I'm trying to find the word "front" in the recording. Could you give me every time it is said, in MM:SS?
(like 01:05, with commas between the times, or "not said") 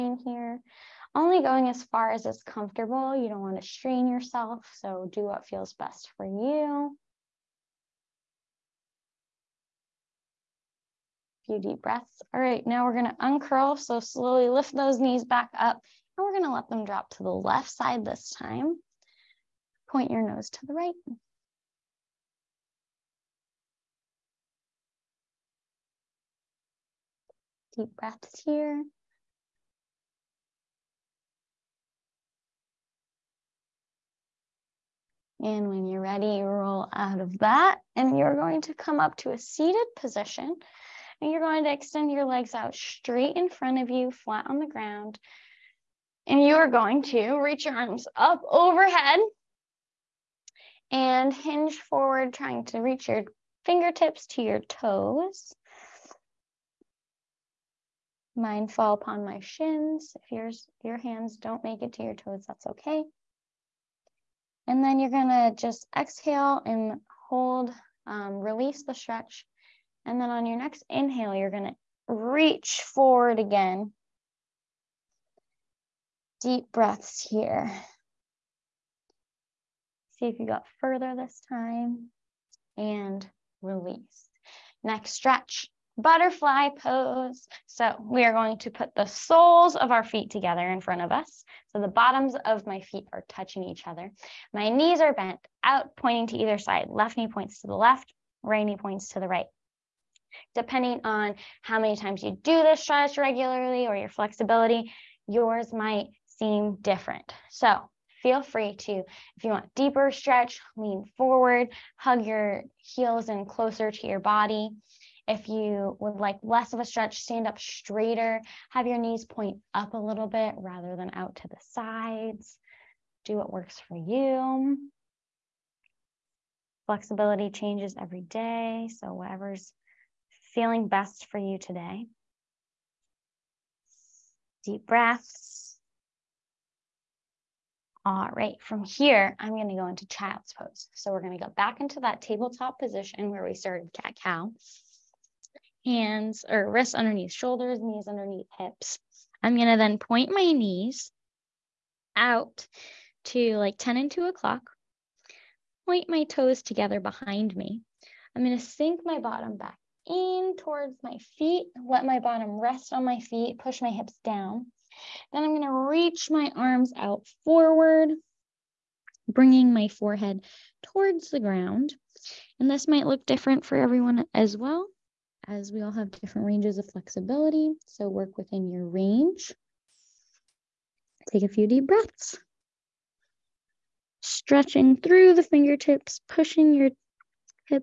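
00:43, 01:30.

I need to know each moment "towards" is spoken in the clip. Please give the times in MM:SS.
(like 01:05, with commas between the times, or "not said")
02:40, 02:50.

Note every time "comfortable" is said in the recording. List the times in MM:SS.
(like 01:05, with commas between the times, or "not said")
00:02.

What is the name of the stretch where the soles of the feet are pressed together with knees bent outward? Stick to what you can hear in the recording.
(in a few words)
Butterfly pose.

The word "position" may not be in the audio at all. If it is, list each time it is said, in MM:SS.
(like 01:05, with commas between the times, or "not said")
00:39, 02:22.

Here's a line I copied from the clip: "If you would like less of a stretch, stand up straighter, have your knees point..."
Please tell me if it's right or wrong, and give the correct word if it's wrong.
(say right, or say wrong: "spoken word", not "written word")
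right.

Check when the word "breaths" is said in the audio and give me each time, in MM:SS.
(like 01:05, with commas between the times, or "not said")
00:11, 00:27, 01:16, 02:14, 03:01.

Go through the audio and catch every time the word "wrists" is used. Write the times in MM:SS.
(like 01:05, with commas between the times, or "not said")
02:26.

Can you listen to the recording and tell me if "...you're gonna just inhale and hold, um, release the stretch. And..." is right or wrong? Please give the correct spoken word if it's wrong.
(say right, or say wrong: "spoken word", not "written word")
wrong: "exhale", not "inhale".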